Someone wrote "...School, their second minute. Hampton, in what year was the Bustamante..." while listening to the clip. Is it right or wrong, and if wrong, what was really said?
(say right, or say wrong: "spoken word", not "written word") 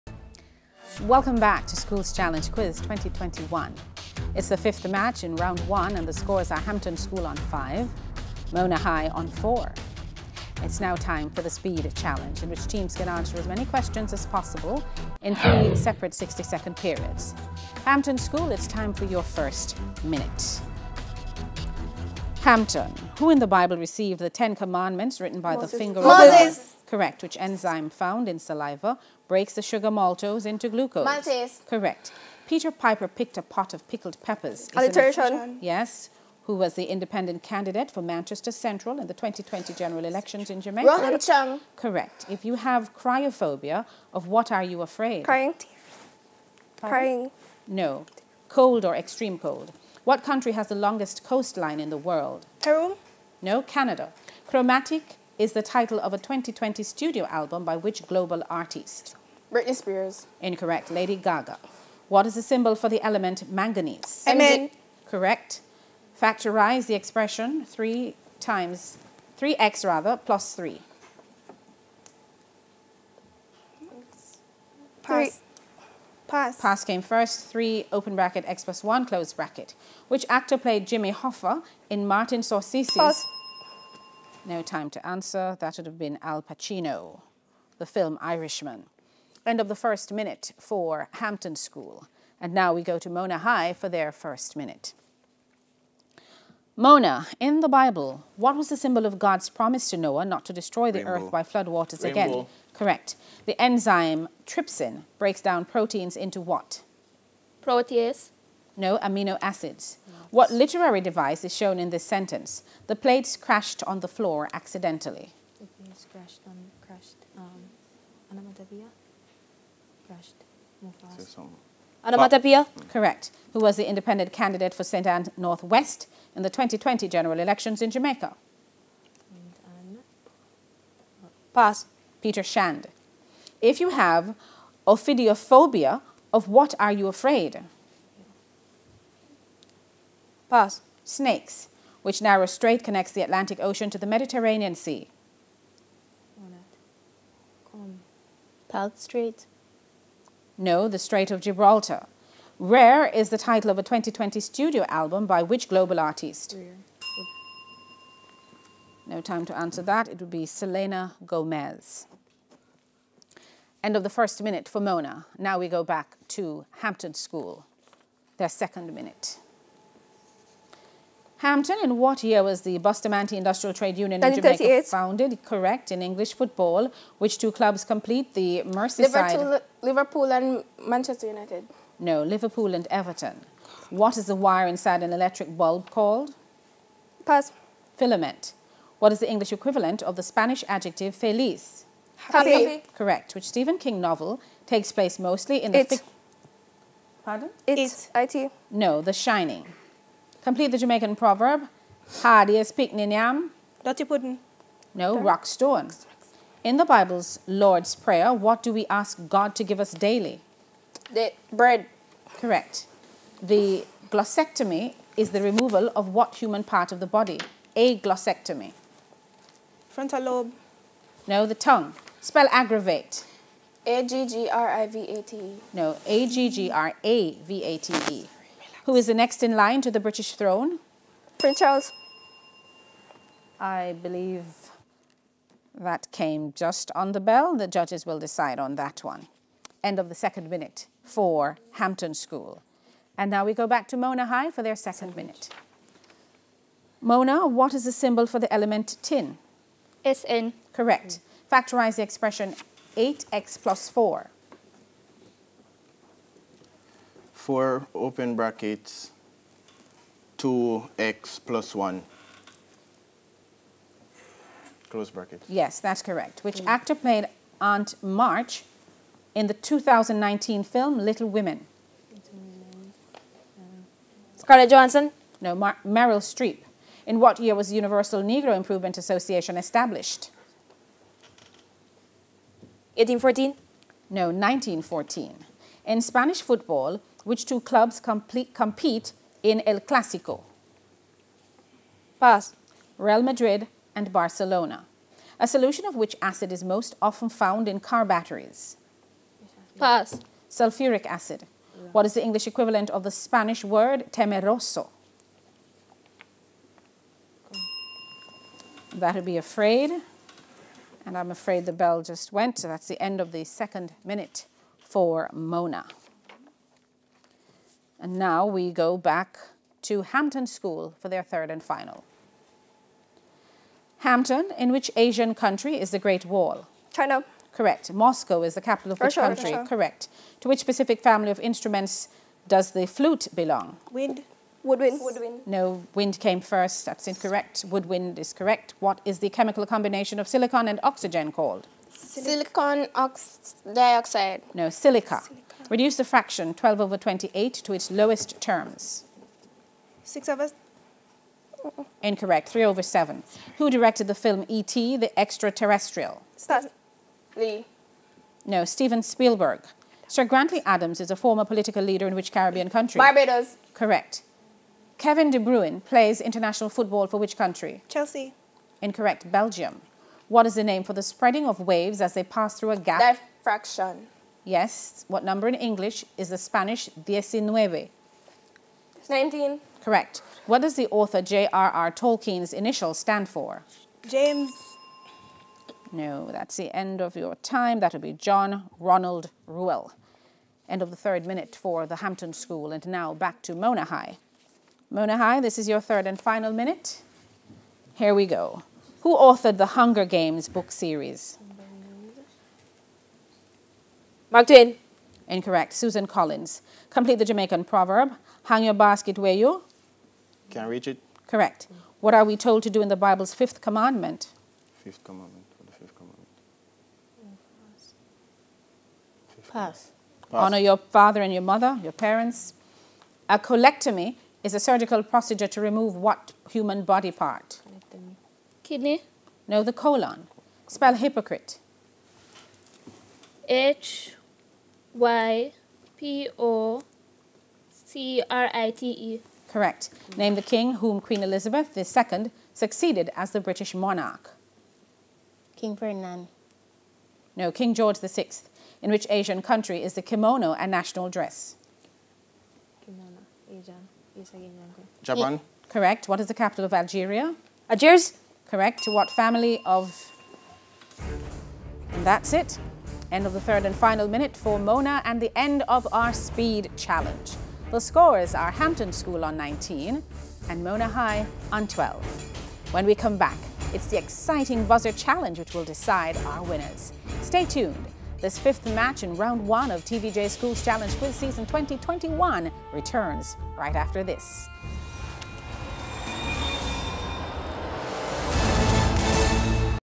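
right.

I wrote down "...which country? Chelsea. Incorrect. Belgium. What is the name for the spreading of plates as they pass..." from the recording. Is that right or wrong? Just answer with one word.
wrong.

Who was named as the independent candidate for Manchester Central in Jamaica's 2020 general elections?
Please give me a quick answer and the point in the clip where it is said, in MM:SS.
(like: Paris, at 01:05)
Rohan Chung, at 00:40.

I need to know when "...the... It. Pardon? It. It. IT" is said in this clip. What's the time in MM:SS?
03:15.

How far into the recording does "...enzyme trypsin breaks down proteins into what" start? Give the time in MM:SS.
01:43.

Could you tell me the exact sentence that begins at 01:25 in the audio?
That would have been Al Pacino, the film Irishman.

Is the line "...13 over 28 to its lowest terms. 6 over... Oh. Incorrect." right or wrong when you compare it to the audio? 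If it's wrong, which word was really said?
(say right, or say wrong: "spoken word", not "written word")
wrong: "12", not "13".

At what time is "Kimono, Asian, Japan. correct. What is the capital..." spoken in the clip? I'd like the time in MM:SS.
07:32.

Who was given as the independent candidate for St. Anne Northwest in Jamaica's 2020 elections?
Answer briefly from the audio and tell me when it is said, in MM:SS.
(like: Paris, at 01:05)
Peter Shand, at 02:12.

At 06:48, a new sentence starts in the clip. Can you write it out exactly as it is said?
Hang your basket where you can reach it.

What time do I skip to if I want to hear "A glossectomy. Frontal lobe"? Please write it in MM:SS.
03:37.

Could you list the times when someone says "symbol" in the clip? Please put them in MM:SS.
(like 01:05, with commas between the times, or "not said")
01:02, 01:38, 04:07.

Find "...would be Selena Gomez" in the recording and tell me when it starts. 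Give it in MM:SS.
02:40.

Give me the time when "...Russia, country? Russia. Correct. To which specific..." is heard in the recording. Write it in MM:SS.
05:29.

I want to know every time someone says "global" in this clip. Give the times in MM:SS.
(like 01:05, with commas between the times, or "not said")
00:58, 02:35.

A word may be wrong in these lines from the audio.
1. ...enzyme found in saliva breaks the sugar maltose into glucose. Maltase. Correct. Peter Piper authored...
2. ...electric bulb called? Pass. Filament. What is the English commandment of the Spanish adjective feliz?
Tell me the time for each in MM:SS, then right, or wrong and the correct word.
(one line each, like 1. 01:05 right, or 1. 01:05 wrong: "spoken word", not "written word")
1. 00:27 wrong: "picked", not "authored"
2. 03:05 wrong: "equivalent", not "commandment".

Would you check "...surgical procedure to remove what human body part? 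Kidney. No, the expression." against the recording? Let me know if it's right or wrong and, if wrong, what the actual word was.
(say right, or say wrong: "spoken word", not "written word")
wrong: "colon", not "expression".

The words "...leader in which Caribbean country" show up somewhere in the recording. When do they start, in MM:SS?
06:01.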